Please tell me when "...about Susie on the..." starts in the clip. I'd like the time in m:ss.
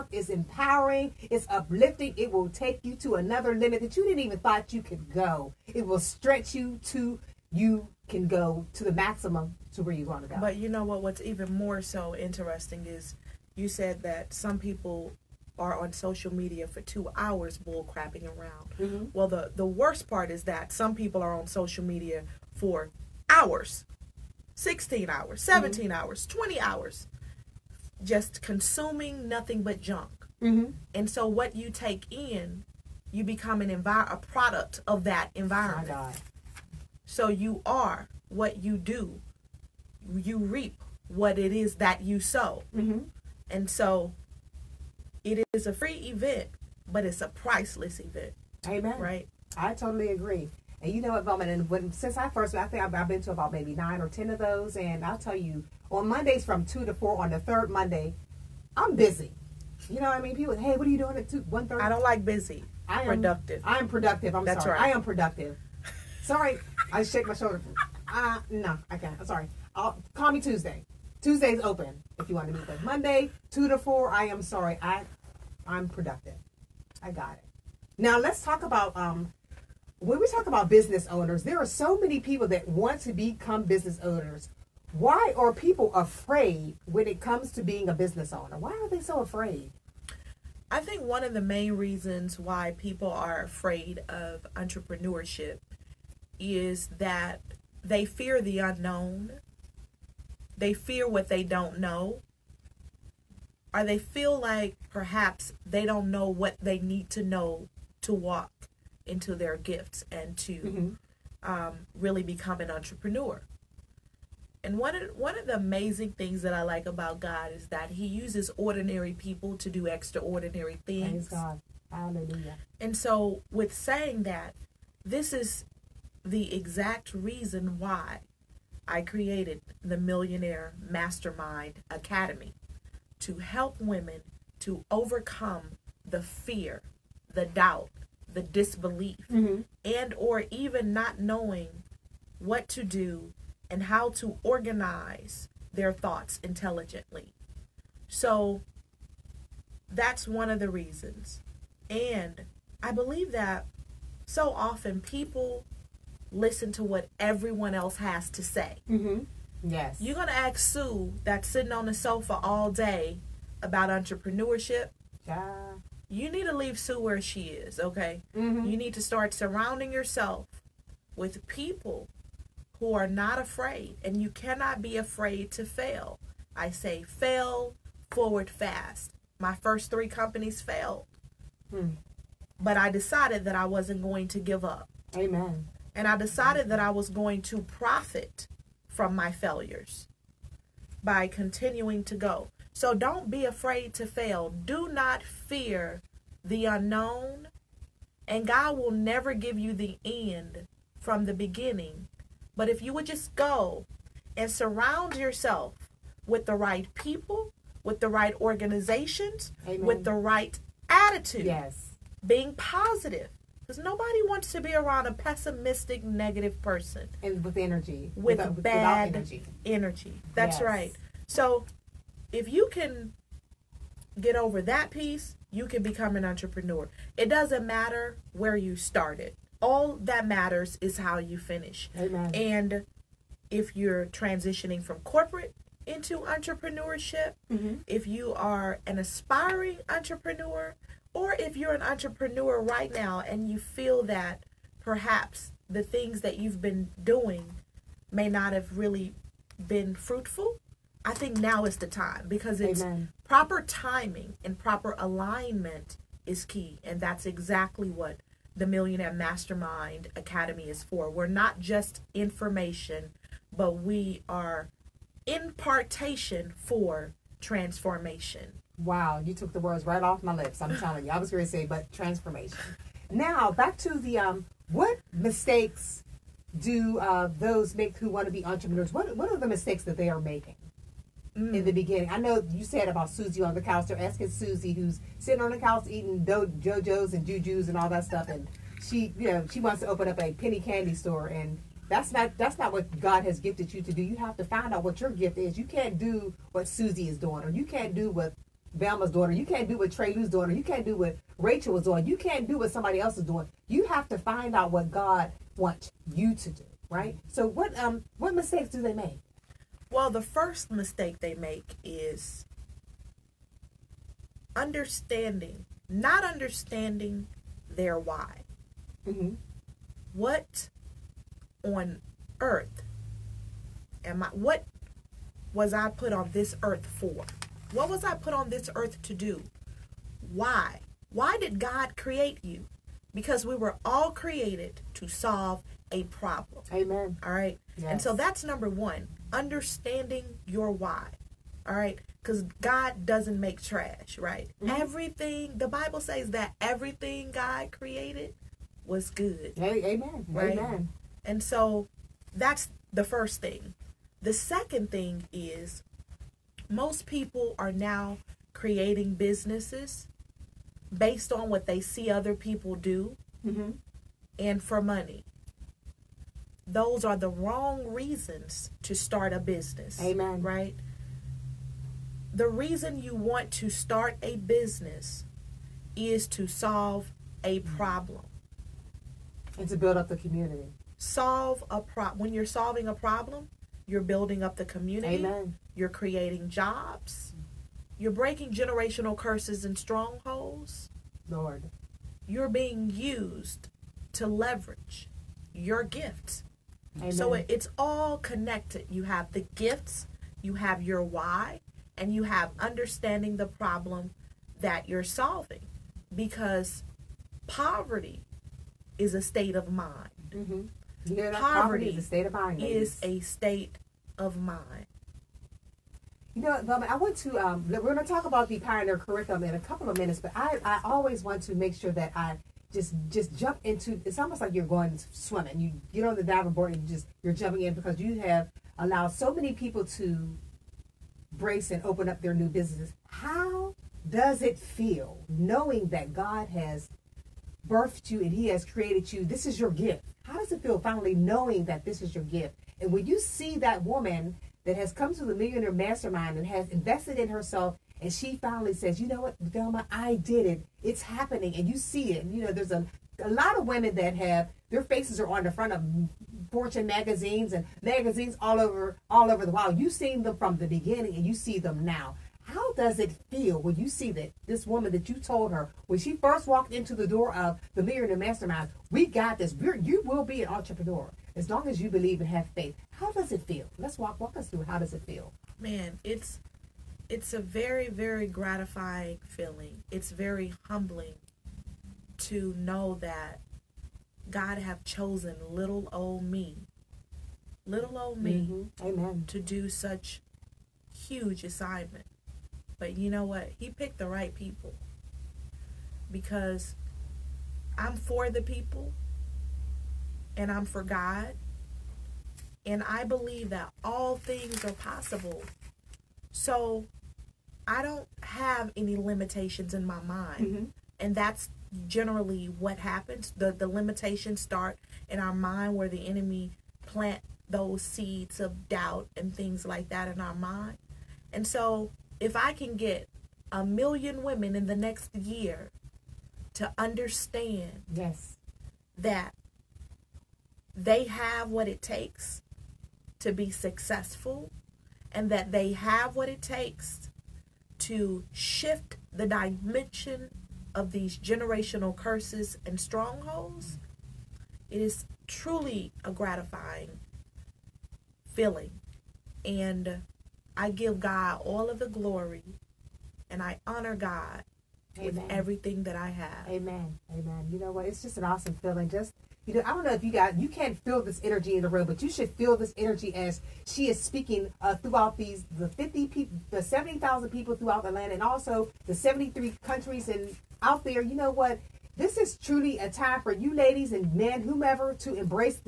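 4:42.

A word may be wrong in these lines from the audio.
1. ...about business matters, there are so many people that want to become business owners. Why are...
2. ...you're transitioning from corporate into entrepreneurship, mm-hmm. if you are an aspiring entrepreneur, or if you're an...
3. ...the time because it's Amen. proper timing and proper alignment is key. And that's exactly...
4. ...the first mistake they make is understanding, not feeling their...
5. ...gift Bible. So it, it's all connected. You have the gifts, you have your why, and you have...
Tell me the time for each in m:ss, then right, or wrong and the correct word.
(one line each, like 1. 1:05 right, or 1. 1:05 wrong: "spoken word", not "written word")
1. 1:20 wrong: "owners", not "matters"
2. 3:53 right
3. 4:11 right
4. 5:10 wrong: "understanding", not "feeling"
5. 6:35 wrong: "Amen", not "Bible".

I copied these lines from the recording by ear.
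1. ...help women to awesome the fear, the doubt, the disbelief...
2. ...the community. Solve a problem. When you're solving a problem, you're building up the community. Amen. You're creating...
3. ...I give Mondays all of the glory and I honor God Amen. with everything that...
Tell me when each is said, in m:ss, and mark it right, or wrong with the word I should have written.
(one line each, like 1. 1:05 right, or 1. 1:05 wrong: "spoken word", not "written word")
1. 2:13 wrong: "overcome", not "awesome"
2. 6:20 right
3. 9:10 wrong: "God", not "Mondays".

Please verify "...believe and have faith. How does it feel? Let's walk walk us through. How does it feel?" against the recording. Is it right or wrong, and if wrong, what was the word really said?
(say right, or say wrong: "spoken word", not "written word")
right.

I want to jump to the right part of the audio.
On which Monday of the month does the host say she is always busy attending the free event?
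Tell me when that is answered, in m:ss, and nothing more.
0:57.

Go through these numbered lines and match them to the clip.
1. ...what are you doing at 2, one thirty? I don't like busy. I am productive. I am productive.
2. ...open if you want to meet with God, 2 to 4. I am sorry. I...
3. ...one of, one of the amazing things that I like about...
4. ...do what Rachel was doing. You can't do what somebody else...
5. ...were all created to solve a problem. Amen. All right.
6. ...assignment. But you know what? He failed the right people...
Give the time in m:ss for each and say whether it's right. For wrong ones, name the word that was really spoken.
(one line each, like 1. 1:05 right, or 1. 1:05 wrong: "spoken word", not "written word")
1. 1:00 right
2. 1:11 wrong: "Monday", not "God"
3. 1:54 right
4. 5:00 right
5. 5:33 right
6. 8:11 wrong: "picked", not "failed".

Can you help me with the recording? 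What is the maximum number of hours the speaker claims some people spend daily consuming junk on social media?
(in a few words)
20 hours.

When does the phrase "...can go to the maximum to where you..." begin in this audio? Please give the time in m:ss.
0:08.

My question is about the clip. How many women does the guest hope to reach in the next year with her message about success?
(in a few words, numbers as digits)
1 million.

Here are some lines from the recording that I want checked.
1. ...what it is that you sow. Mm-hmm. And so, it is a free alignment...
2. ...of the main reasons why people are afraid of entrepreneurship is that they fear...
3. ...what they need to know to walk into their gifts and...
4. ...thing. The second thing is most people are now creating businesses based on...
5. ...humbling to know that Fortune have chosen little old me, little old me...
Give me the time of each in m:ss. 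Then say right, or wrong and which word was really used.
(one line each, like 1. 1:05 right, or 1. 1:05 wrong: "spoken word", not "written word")
1. 0:41 wrong: "event", not "alignment"
2. 1:31 right
3. 1:46 right
4. 5:53 right
5. 8:00 wrong: "God", not "Fortune".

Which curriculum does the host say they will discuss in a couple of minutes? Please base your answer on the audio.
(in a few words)
Pioneer curriculum.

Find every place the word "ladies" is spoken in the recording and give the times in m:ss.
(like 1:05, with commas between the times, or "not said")
6:52, 9:33.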